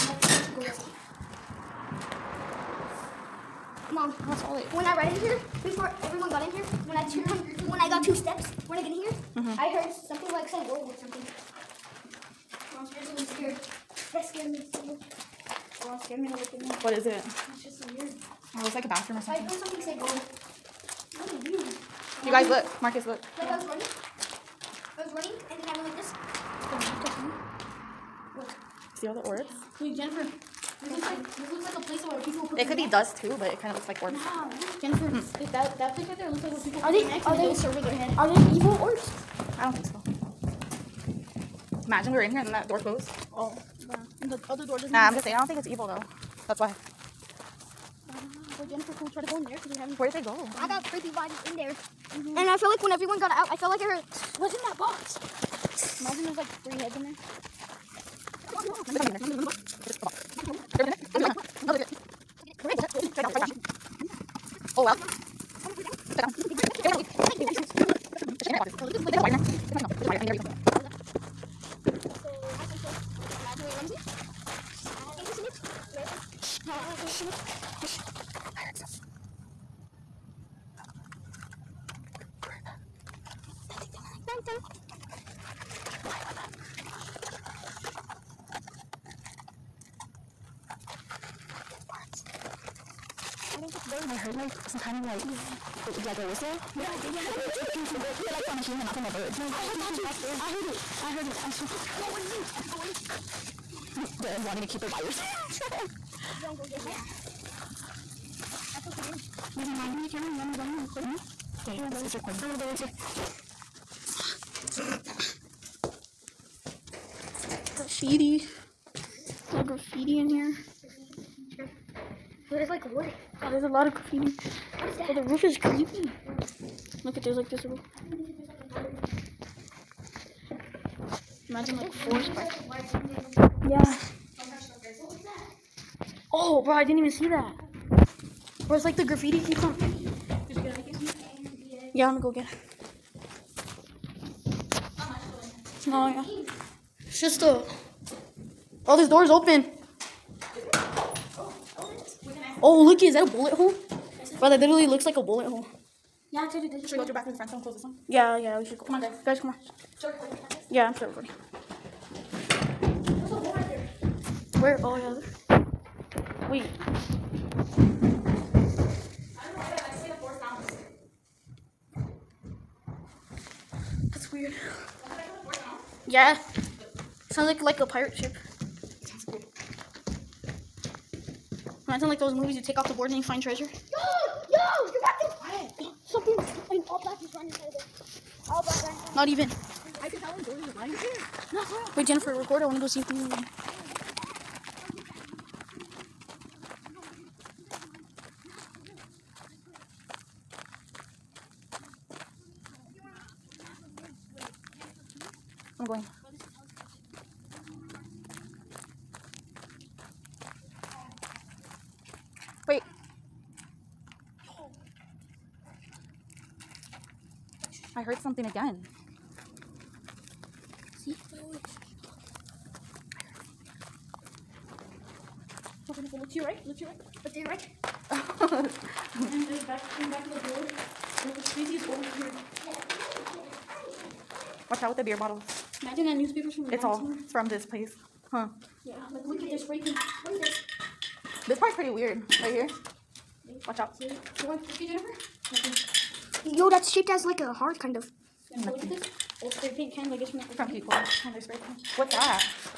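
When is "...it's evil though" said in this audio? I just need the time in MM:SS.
00:45.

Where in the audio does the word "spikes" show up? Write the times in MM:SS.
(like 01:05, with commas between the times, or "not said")
02:12.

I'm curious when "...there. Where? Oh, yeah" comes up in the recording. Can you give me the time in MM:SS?
02:43.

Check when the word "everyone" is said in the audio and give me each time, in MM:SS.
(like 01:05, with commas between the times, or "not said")
00:06, 00:52.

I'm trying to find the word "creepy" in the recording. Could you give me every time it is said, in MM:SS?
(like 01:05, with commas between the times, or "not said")
00:50, 02:05.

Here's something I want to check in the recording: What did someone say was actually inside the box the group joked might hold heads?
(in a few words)
Internet boxes.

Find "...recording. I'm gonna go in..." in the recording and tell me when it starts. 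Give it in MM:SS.
01:52.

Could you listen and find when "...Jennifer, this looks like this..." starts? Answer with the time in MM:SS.
00:29.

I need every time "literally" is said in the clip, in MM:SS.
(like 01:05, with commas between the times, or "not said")
02:34.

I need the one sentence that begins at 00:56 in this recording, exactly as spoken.
Imagine there's like three heads in there.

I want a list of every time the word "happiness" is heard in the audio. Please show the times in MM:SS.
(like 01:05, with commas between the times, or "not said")
not said.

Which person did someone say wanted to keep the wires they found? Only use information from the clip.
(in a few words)
Darren.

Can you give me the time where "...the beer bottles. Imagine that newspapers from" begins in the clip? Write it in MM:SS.
03:54.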